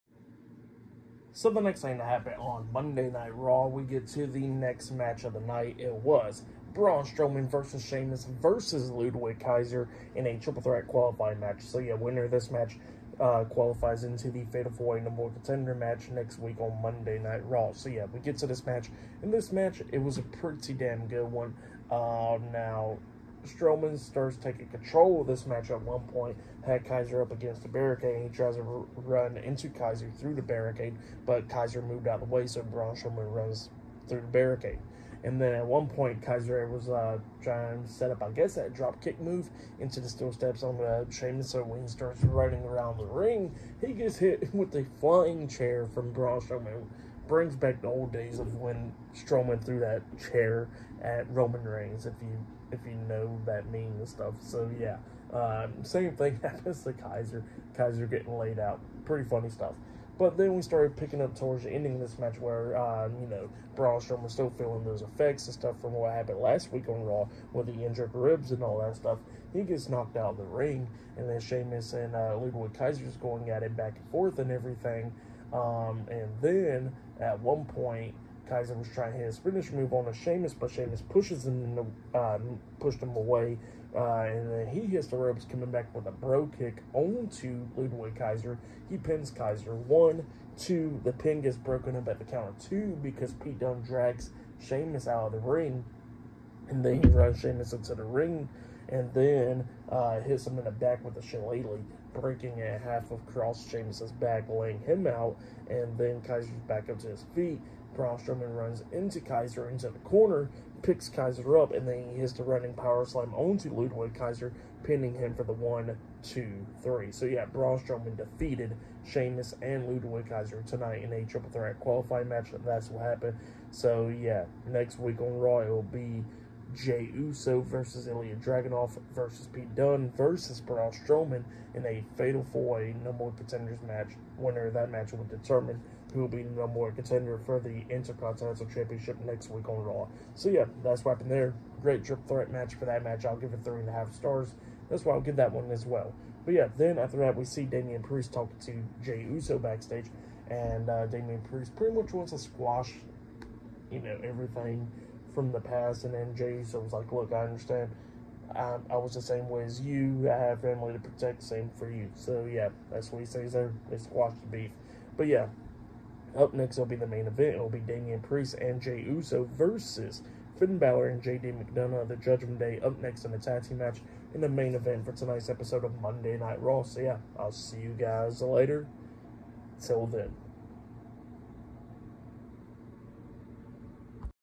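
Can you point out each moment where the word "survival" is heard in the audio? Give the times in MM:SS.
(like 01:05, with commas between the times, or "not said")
not said.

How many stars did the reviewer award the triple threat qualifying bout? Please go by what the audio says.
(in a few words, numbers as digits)
3.5.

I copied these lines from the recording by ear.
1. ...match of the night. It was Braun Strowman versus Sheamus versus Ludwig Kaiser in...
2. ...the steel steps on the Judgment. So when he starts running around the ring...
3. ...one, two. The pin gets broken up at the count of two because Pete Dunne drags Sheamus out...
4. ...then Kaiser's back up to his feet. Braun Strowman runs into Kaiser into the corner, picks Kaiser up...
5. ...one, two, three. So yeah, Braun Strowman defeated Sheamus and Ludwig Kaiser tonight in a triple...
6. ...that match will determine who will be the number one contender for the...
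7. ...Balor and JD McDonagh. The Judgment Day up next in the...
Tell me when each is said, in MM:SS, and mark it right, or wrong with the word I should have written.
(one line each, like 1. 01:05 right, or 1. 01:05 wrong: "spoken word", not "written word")
1. 00:04 right
2. 00:39 wrong: "Sheamus", not "Judgment"
3. 01:29 right
4. 01:45 right
5. 01:55 right
6. 02:14 right
7. 02:50 right.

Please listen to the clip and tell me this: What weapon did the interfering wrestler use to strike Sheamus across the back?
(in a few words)
shillelagh.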